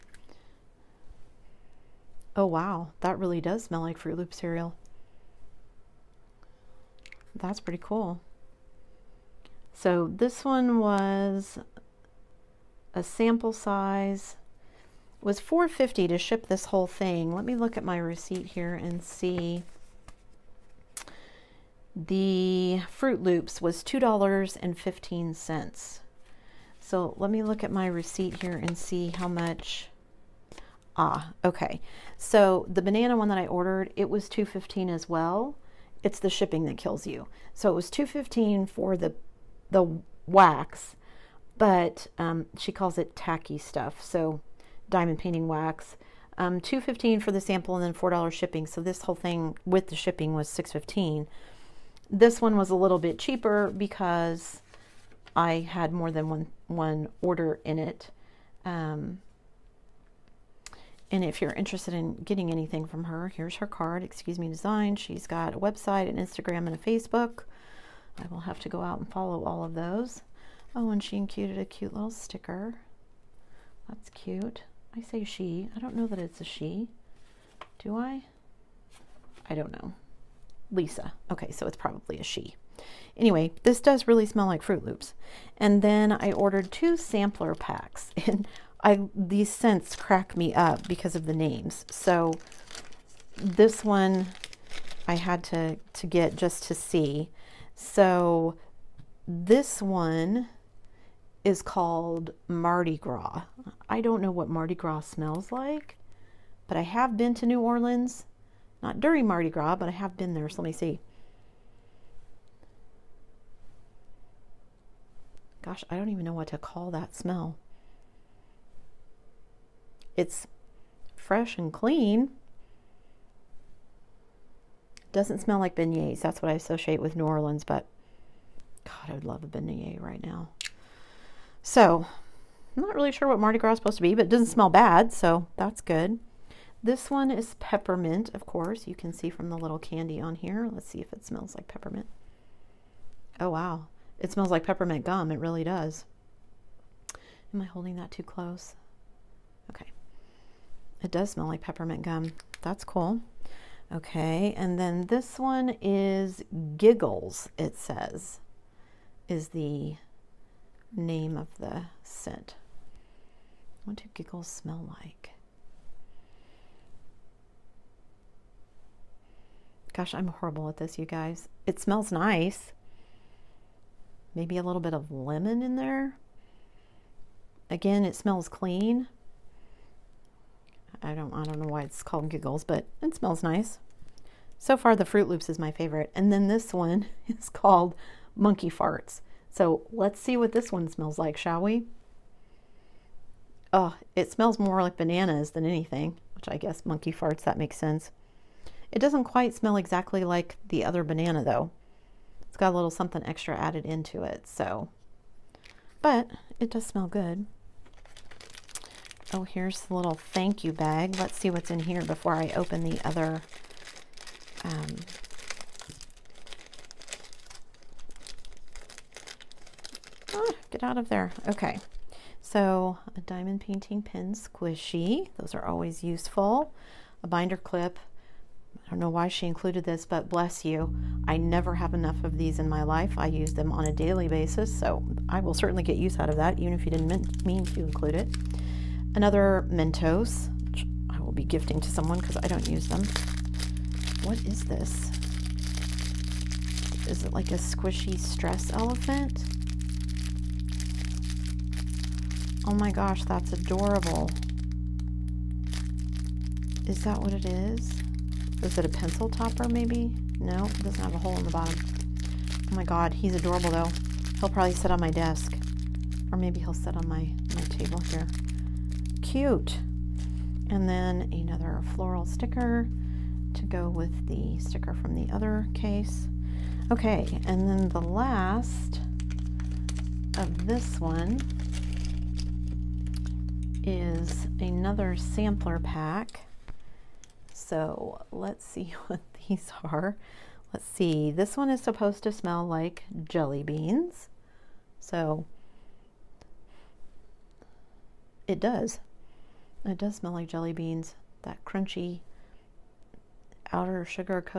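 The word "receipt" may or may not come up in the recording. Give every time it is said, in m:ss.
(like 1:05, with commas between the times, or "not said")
0:17, 0:27.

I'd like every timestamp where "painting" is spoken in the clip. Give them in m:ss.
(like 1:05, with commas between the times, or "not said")
0:45, 3:43.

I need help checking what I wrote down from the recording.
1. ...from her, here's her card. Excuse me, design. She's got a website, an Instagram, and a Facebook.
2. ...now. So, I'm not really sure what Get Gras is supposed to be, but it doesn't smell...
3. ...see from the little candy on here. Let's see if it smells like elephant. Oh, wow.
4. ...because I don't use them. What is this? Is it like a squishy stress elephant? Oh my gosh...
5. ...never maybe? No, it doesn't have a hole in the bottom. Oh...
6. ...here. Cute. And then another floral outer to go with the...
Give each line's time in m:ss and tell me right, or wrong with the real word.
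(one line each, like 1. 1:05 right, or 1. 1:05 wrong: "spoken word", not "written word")
1. 1:02 right
2. 2:10 wrong: "Mardi", not "Get"
3. 2:19 wrong: "peppermint", not "elephant"
4. 4:02 right
5. 4:19 wrong: "topper", not "never"
6. 4:28 wrong: "sticker", not "outer".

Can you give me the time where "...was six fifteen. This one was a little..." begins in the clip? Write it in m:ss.
0:50.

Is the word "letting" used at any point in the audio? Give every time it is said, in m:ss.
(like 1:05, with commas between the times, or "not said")
not said.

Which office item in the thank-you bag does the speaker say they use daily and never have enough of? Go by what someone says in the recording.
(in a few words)
binder clip.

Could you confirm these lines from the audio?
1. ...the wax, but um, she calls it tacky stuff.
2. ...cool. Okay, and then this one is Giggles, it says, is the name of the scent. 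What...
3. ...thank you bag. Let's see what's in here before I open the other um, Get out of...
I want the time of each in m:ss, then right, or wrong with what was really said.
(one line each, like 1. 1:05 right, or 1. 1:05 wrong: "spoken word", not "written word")
1. 0:39 right
2. 2:32 right
3. 3:30 right.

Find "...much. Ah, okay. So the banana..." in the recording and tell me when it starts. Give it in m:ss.
0:29.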